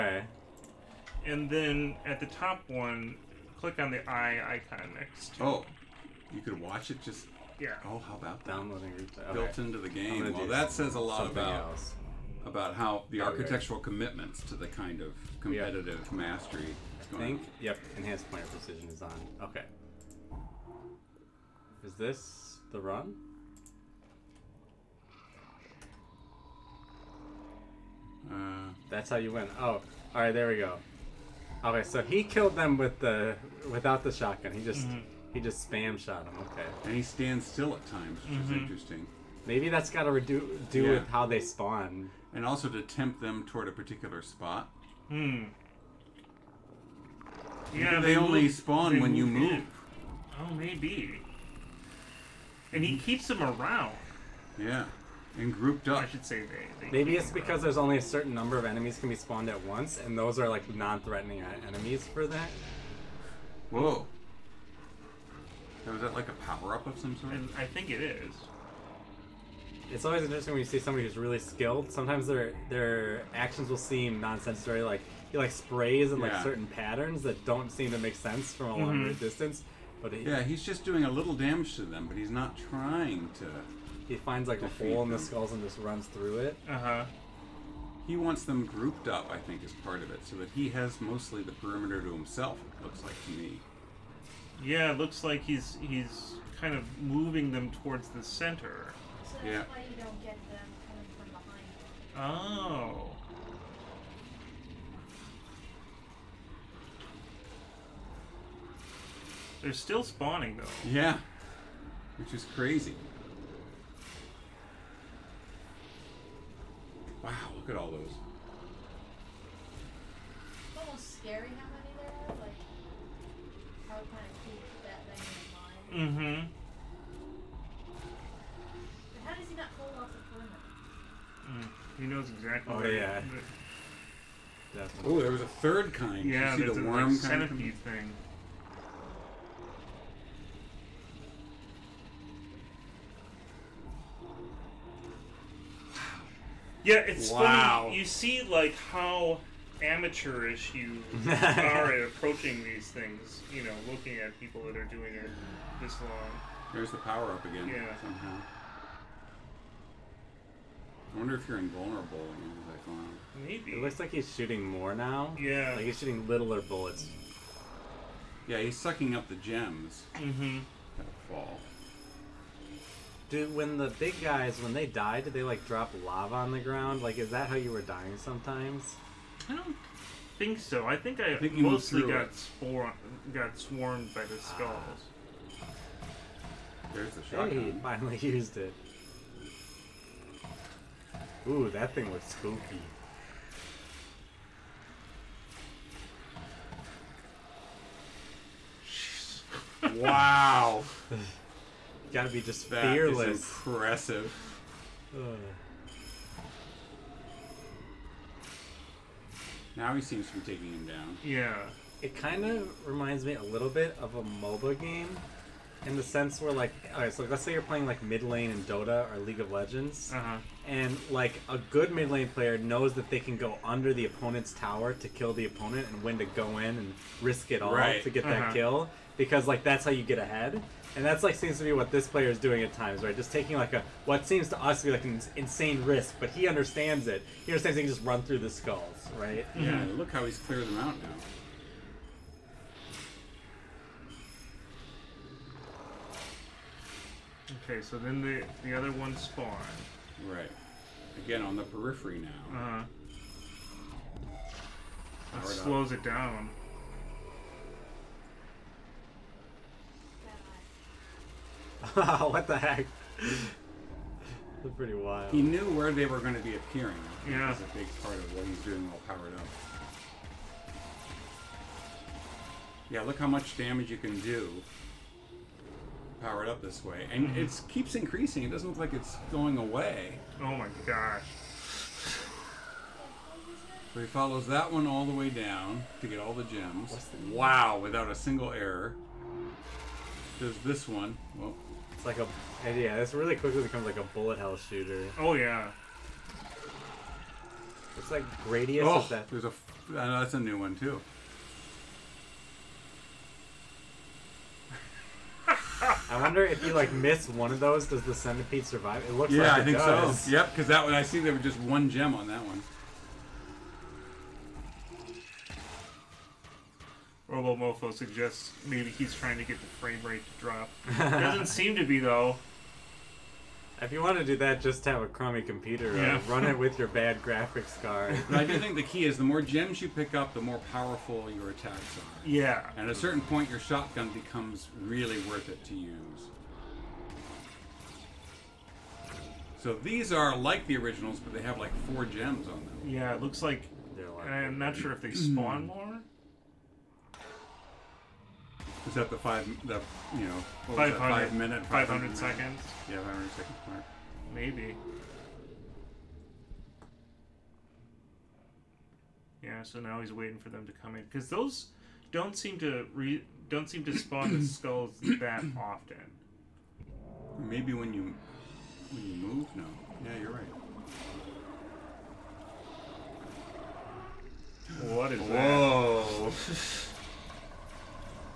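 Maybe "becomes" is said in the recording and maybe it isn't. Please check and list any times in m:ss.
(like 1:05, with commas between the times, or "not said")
4:53, 5:34.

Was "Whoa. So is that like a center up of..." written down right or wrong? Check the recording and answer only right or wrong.
wrong.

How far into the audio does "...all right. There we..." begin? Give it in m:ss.
0:29.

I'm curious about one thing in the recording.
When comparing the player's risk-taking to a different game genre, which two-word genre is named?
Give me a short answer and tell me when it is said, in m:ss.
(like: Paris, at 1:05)
MOBA, at 3:34.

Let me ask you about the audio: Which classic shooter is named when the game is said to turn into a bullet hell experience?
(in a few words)
Gradius.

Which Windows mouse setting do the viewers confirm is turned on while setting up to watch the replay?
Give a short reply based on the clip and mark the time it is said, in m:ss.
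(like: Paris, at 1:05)
Enhanced pointer precision, at 0:17.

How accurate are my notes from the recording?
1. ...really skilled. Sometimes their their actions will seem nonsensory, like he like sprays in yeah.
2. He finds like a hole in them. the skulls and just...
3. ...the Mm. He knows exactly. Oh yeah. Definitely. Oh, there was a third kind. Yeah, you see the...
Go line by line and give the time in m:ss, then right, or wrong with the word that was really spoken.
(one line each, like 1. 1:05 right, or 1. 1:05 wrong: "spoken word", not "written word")
1. 1:11 right
2. 1:24 right
3. 2:10 right.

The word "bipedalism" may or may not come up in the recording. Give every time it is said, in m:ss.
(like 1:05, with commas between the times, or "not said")
not said.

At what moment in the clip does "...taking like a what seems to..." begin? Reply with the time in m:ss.
3:53.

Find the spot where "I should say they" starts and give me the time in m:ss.
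0:56.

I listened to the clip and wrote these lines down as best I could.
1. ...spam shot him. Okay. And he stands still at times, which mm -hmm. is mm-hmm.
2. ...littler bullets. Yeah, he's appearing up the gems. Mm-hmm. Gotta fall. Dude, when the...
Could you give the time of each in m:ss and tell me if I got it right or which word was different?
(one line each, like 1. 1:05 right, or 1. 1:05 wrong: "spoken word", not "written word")
1. 0:35 right
2. 2:46 wrong: "sucking", not "appearing".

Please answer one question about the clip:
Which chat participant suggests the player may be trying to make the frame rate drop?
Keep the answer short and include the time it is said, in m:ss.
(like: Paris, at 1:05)
Robomofo, at 5:17.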